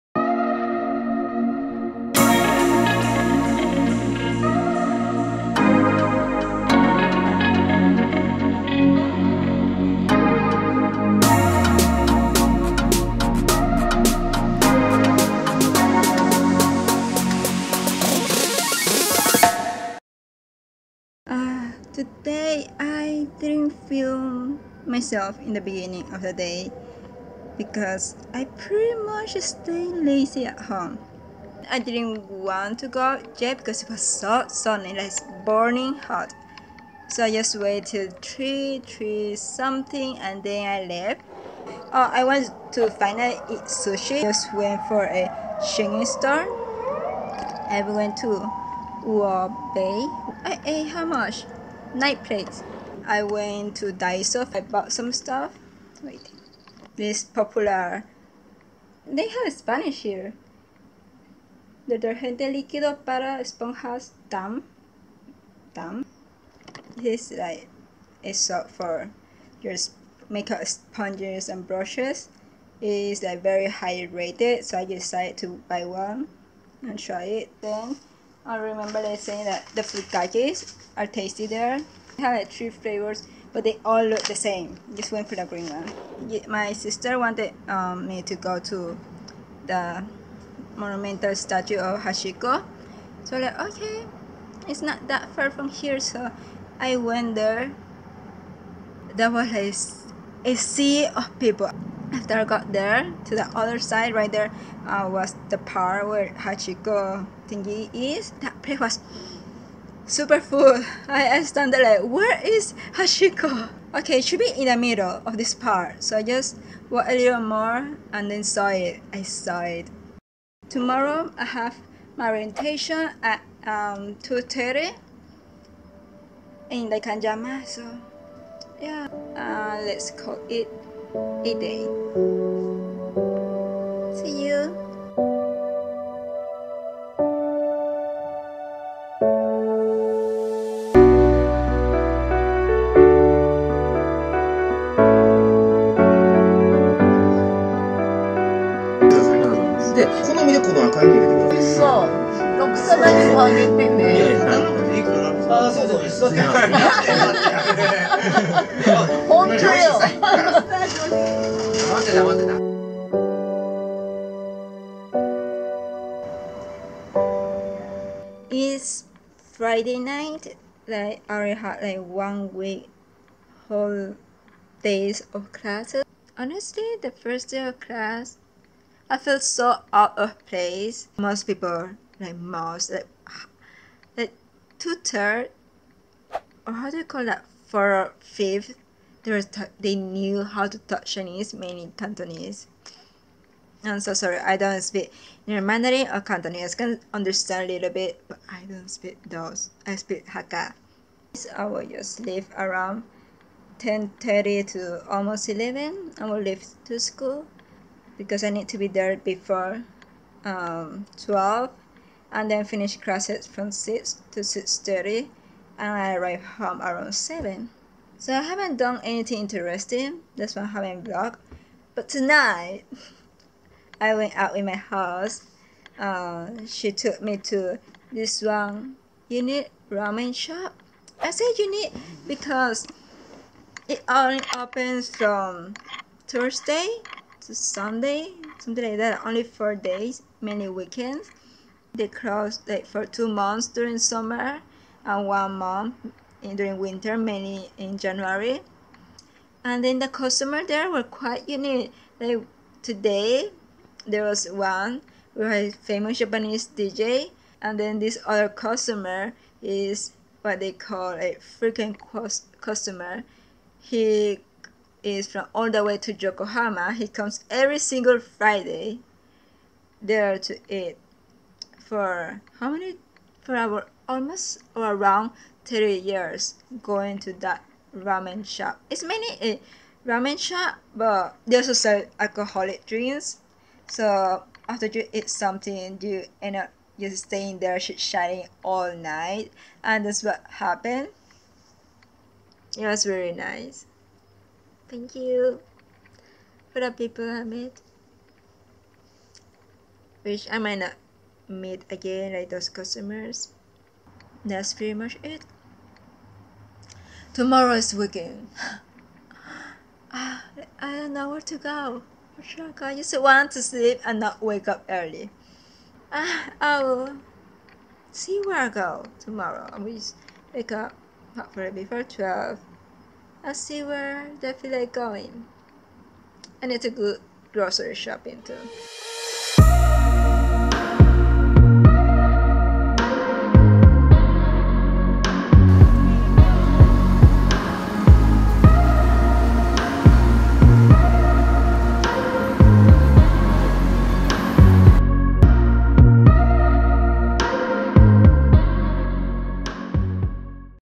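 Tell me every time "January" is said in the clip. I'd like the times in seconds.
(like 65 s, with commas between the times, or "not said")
247 s.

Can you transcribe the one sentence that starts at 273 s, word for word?
For our almost or around three years going to that ramen shop.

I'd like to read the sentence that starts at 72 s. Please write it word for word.
It is like very high rated, so I decided to buy one and try it.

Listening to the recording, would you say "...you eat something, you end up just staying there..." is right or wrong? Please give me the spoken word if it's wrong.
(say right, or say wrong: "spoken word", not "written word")
right.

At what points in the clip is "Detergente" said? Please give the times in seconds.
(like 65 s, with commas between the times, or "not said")
61 s.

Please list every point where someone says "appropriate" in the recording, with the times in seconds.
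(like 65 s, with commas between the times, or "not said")
not said.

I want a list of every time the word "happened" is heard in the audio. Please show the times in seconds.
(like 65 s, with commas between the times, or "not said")
290 s.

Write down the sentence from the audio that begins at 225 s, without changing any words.
Uh, she took me to this one unit ramen shop.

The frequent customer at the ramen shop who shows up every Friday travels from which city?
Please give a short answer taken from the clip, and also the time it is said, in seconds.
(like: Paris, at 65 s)
Yokohama, at 266 s.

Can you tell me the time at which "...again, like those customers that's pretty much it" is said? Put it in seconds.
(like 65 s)
301 s.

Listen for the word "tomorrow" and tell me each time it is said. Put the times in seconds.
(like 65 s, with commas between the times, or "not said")
120 s, 307 s, 319 s.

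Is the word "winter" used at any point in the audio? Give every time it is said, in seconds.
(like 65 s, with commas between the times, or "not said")
246 s.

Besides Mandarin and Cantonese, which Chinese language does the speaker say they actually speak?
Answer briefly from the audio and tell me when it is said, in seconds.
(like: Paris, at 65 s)
Hakka, at 200 s.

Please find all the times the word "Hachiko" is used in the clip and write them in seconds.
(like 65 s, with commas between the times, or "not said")
92 s, 106 s, 112 s.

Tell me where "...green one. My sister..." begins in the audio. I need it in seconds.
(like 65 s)
85 s.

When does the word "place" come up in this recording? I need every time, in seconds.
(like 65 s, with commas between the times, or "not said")
108 s, 180 s.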